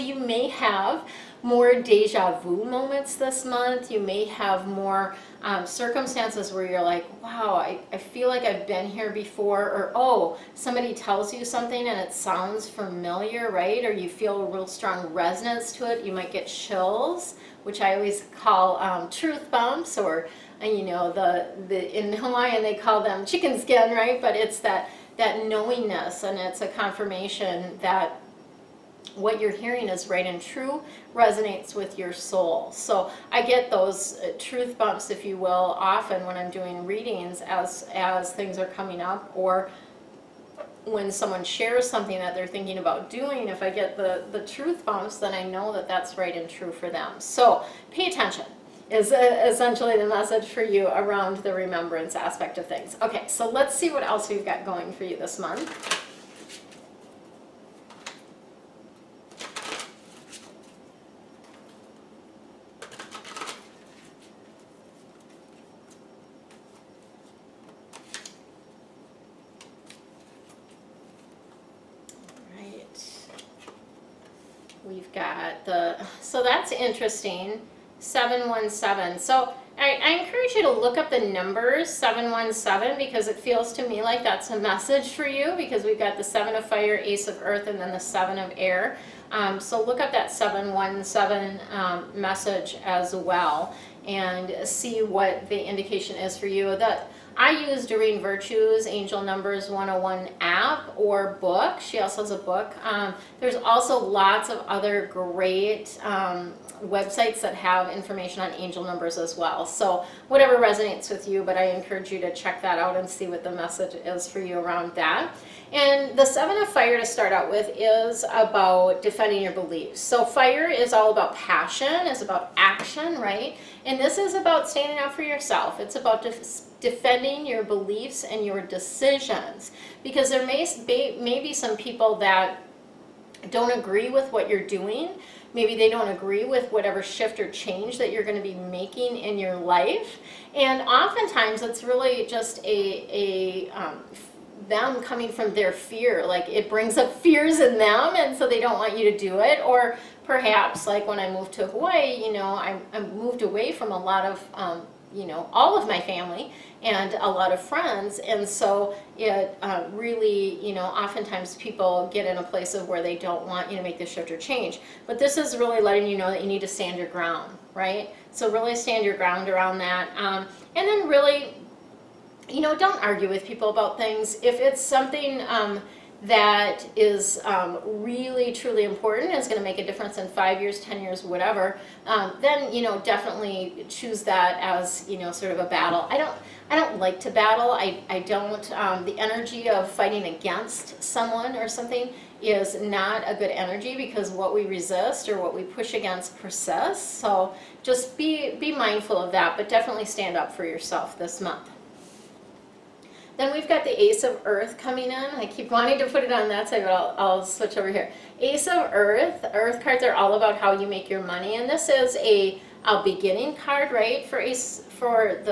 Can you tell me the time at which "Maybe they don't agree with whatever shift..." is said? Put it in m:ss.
2:15.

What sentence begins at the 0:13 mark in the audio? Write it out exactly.
Or you feel a real strong resonance to it.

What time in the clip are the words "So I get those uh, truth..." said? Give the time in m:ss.
0:32.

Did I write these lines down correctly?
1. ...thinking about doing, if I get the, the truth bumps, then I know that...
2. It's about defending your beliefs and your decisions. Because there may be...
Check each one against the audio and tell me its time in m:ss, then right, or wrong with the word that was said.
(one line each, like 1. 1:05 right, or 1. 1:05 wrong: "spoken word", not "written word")
1. 0:42 right
2. 2:05 right.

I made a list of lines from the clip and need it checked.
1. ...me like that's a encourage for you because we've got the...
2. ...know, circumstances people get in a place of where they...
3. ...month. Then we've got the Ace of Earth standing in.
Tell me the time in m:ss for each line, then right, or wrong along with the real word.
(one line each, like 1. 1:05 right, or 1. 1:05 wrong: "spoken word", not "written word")
1. 1:23 wrong: "message", not "encourage"
2. 2:40 wrong: "oftentimes", not "circumstances"
3. 3:21 wrong: "coming", not "standing".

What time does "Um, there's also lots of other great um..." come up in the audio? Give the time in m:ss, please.
1:42.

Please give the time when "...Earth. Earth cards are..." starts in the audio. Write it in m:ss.
3:28.